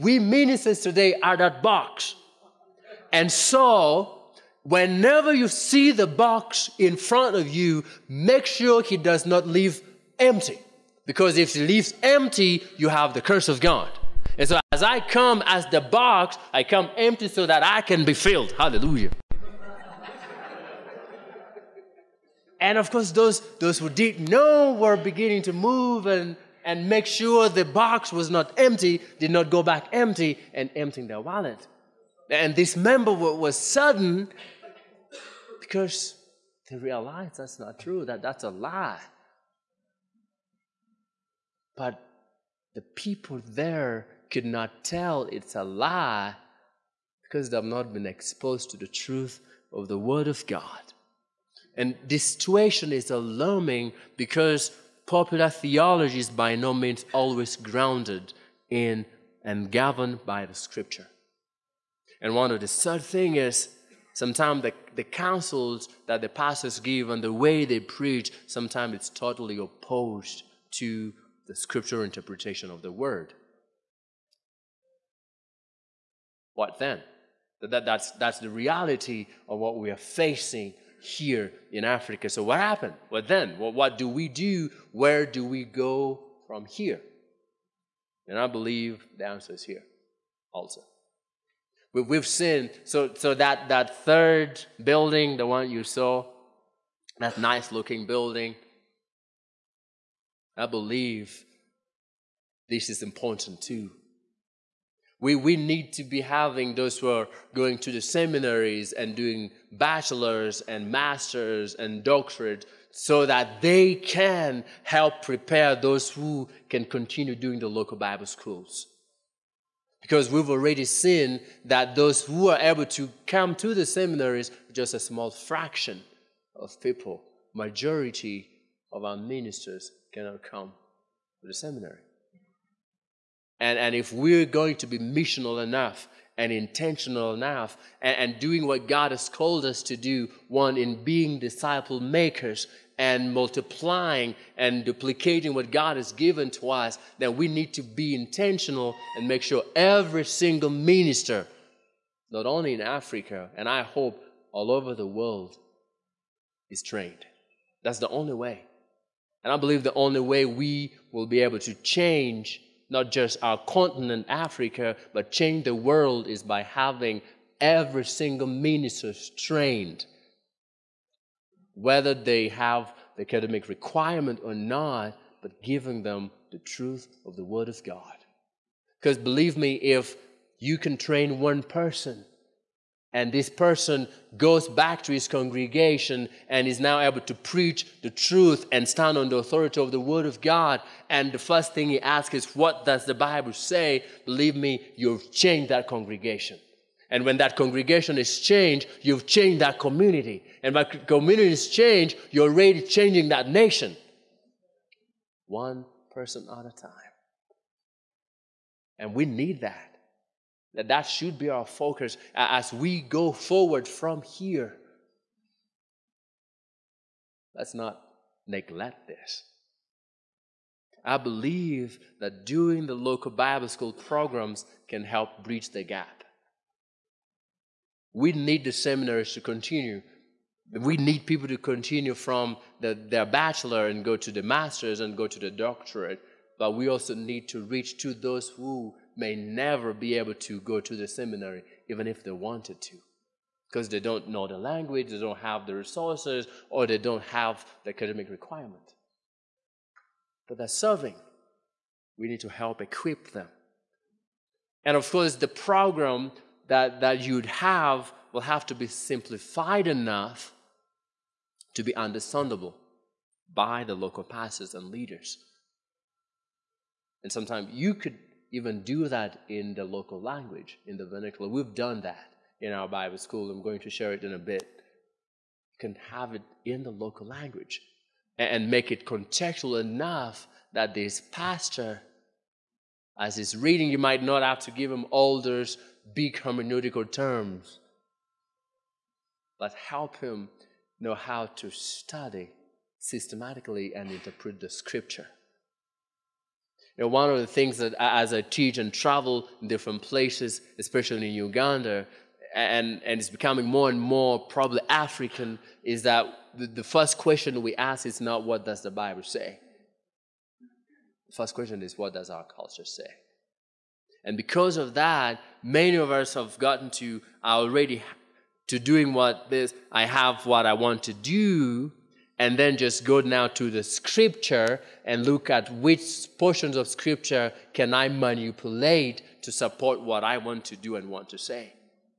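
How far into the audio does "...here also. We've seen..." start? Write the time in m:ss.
1:29.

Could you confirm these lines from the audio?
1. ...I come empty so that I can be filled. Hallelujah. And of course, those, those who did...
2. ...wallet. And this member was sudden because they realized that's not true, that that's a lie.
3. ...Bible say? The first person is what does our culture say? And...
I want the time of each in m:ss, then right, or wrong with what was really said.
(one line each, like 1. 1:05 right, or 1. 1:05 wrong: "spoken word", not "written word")
1. 0:16 right
2. 0:31 right
3. 5:08 wrong: "question", not "person".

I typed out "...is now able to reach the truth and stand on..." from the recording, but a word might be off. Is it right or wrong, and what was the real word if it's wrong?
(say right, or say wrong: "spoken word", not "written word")
wrong: "preach", not "reach".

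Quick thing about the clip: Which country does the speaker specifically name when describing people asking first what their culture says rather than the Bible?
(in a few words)
Uganda.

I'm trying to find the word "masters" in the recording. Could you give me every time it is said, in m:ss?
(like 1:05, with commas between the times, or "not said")
1:50, 3:54.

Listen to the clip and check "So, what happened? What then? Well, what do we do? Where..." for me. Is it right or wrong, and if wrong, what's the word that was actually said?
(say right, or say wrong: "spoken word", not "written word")
right.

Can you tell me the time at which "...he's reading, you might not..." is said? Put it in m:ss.
4:43.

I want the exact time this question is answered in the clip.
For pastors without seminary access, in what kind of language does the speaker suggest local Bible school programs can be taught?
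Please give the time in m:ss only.
4:31.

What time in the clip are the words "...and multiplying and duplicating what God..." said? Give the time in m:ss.
2:22.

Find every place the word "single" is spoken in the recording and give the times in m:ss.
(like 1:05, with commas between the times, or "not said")
2:30, 2:48.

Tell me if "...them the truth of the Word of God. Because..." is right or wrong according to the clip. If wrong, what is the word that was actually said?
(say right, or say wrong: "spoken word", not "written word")
right.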